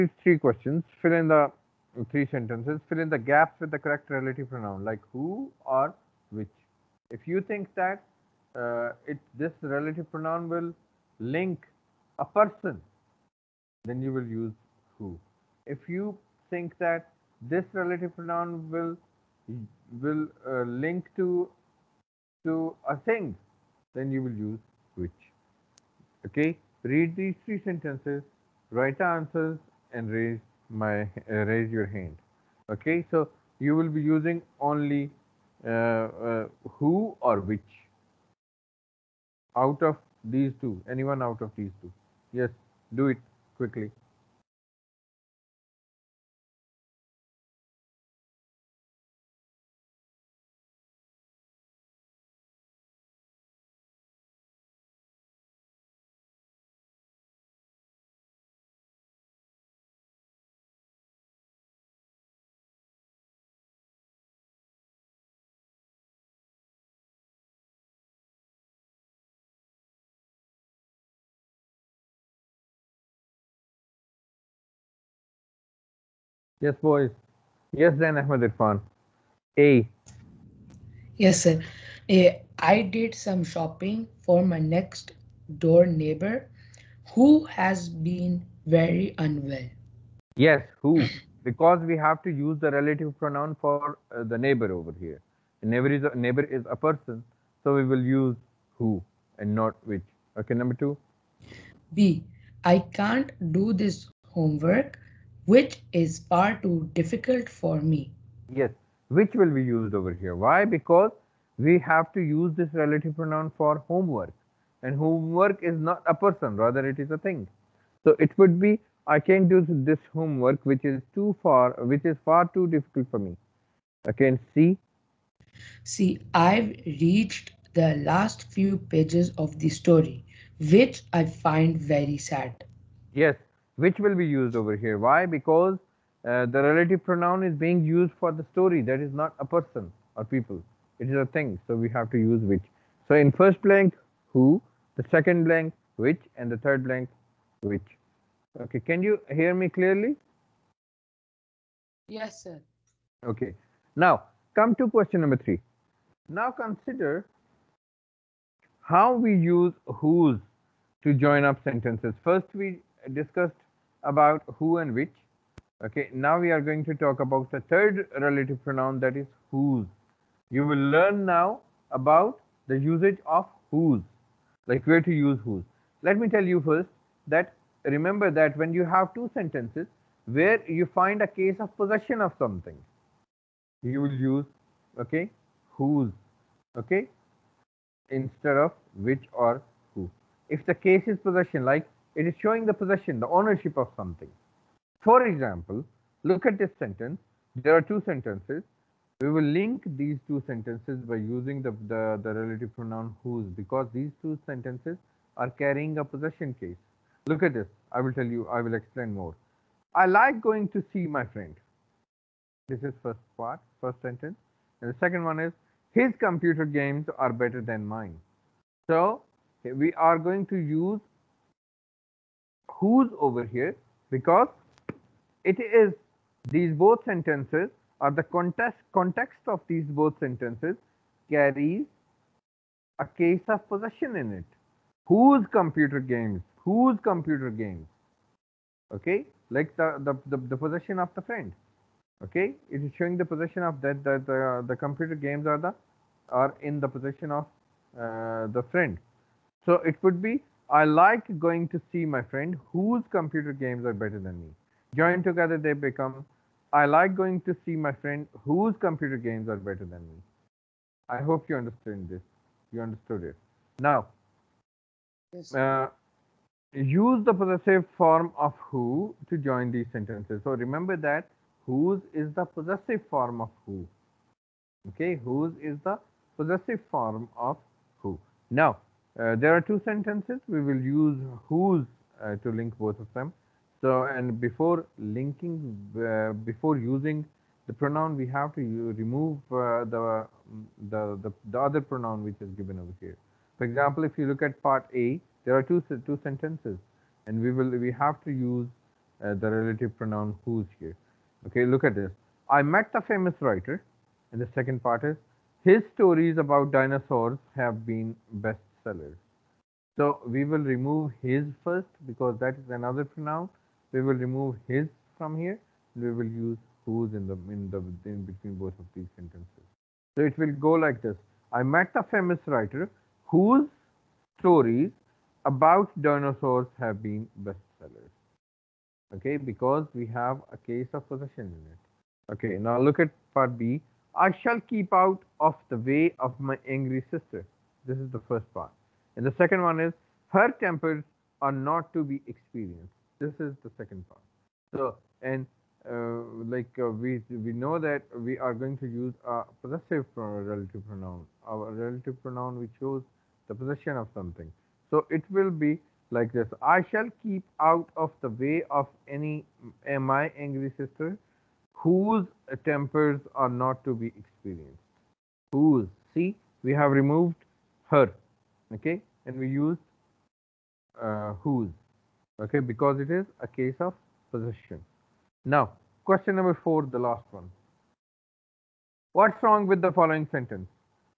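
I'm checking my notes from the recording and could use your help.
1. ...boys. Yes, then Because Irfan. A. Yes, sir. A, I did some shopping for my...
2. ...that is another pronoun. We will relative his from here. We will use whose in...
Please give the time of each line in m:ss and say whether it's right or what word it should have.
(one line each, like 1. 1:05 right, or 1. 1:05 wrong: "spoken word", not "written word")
1. 1:16 wrong: "Ahmed", not "Because"
2. 5:12 wrong: "remove", not "relative".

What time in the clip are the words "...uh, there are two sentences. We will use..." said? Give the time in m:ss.
4:39.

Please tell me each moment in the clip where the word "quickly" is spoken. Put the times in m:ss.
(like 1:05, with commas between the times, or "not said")
0:43.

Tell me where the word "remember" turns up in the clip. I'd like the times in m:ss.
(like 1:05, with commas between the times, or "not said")
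2:57, 4:30.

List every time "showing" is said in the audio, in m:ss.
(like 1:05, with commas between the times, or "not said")
3:12, 4:02.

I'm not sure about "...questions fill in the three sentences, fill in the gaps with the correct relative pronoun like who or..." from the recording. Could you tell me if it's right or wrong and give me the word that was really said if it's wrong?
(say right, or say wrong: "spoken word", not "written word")
right.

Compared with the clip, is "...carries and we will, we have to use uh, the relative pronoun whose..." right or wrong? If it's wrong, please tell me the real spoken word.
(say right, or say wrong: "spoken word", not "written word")
wrong: "sentences", not "carries".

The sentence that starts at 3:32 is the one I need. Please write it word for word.
This is first part, first sentence.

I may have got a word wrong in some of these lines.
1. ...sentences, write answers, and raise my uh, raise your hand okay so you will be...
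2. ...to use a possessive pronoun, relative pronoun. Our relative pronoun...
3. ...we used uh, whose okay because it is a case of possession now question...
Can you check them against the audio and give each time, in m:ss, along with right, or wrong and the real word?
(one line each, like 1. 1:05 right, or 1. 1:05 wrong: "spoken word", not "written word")
1. 0:27 right
2. 5:48 right
3. 6:09 right.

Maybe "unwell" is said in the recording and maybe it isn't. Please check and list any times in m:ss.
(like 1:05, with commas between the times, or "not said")
1:29.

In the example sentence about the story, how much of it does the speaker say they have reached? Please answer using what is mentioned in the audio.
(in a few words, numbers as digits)
the last few pages.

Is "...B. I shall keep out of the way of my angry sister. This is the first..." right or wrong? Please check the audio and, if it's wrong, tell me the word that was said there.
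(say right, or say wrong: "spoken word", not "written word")
right.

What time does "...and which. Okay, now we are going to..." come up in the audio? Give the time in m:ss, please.
2:44.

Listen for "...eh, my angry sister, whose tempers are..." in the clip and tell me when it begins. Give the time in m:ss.
5:59.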